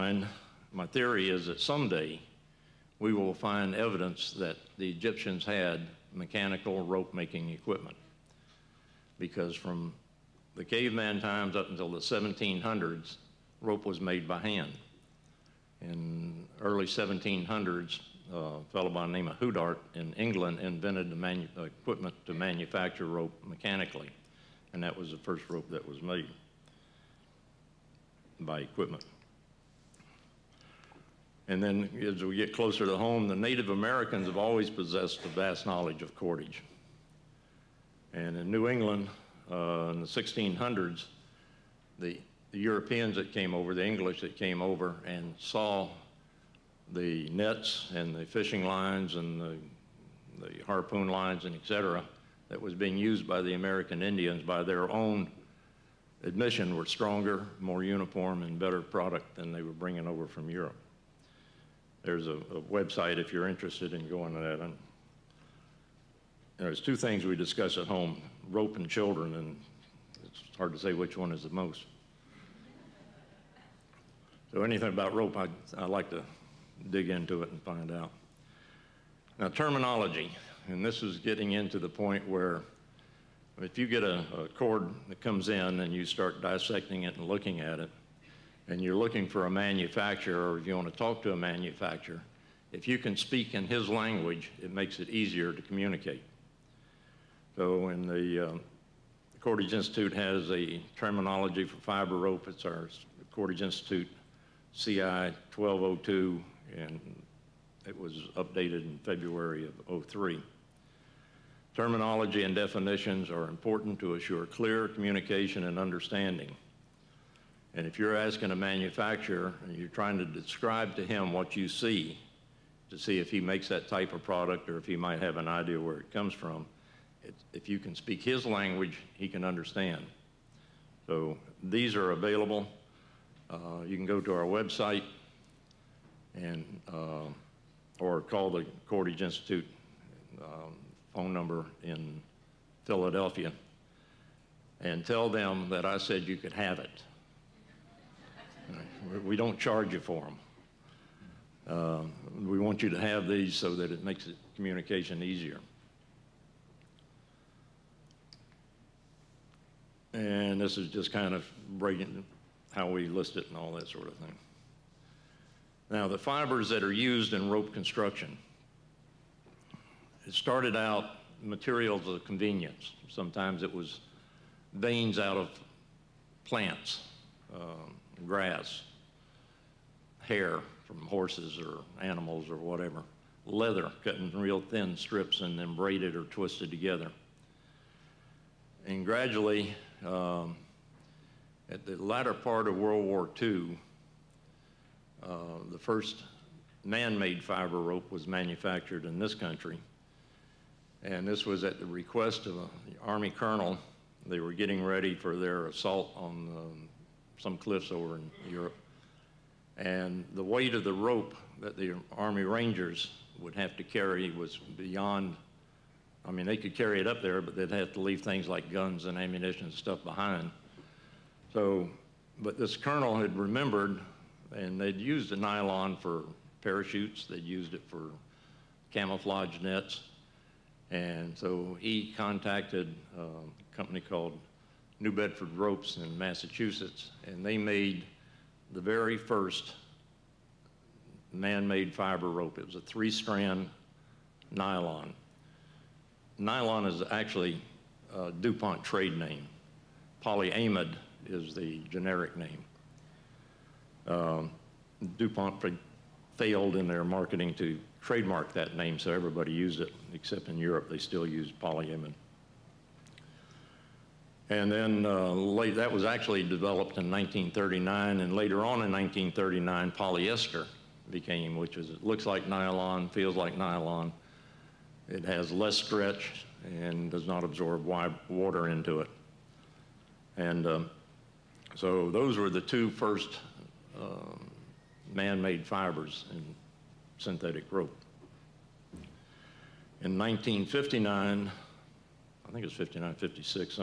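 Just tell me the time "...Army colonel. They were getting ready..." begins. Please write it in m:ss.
3:23.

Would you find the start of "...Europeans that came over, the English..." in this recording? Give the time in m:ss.
0:42.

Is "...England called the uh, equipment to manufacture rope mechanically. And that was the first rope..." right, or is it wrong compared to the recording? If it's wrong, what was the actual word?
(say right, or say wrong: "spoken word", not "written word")
wrong: "invented", not "called".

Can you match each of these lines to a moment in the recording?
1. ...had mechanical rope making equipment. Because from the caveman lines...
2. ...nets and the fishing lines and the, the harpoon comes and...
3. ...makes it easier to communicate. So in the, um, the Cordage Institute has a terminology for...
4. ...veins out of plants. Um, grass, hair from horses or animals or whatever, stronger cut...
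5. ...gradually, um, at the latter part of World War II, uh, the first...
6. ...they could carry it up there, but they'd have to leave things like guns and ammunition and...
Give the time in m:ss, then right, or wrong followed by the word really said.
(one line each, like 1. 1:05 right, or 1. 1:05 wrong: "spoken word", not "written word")
1. 0:05 wrong: "times", not "lines"
2. 0:47 wrong: "lines", not "comes"
3. 1:34 right
4. 2:54 wrong: "leather", not "stronger"
5. 3:09 right
6. 3:36 right.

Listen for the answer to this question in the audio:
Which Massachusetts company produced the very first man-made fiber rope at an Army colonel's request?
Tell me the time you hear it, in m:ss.
3:55.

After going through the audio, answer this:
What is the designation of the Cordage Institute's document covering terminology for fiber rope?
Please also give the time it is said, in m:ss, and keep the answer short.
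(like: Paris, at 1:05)
CI 1202, at 1:44.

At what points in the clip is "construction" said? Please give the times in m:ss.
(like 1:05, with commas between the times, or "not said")
2:47.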